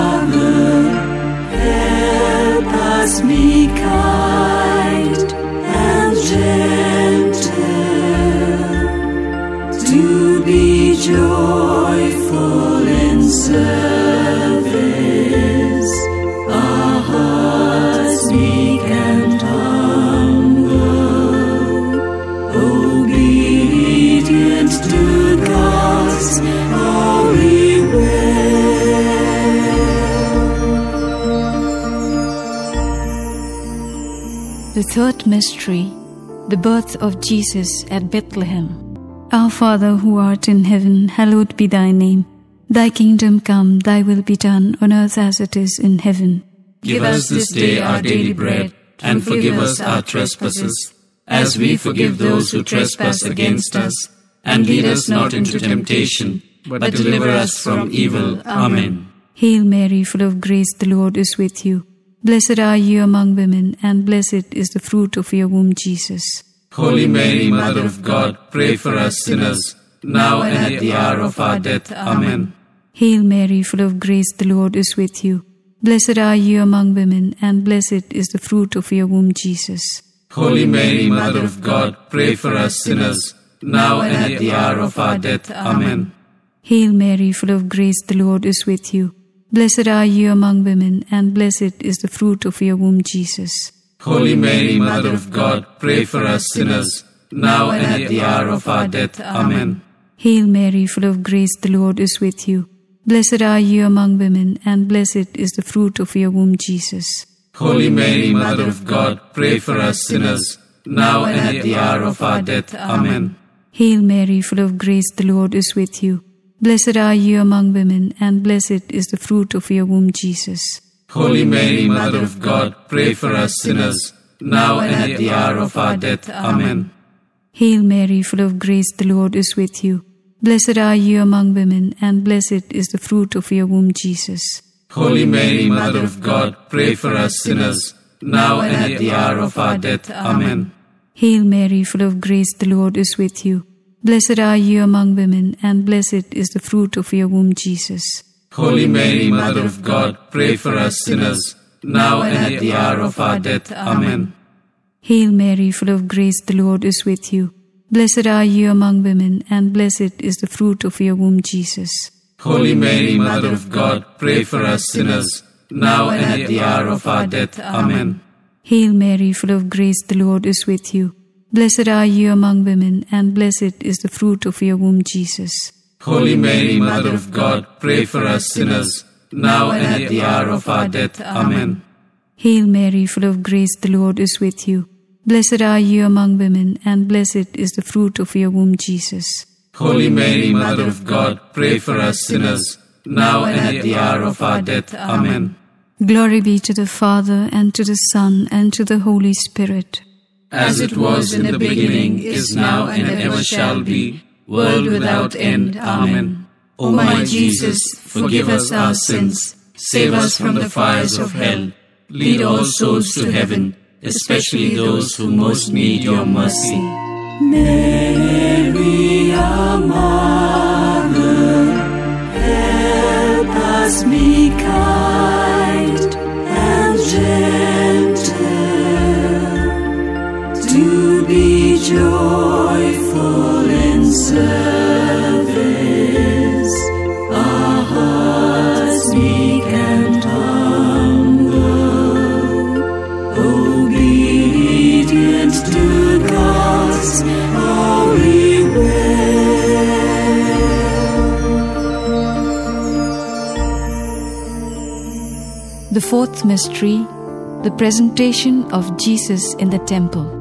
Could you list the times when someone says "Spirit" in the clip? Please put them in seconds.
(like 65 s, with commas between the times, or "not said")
199 s.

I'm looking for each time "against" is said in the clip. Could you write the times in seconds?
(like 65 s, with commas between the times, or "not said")
53 s.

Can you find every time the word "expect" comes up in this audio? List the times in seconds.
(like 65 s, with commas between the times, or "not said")
not said.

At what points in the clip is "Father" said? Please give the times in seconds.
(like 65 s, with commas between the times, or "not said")
39 s, 196 s.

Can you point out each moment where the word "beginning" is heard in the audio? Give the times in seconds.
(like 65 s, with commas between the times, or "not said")
201 s.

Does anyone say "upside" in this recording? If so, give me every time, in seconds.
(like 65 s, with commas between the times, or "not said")
not said.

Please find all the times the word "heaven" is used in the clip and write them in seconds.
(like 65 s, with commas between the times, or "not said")
40 s, 45 s, 213 s.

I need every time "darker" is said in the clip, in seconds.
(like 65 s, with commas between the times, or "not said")
not said.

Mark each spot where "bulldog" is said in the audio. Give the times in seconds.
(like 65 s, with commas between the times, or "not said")
not said.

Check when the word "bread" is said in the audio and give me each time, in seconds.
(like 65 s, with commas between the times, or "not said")
48 s.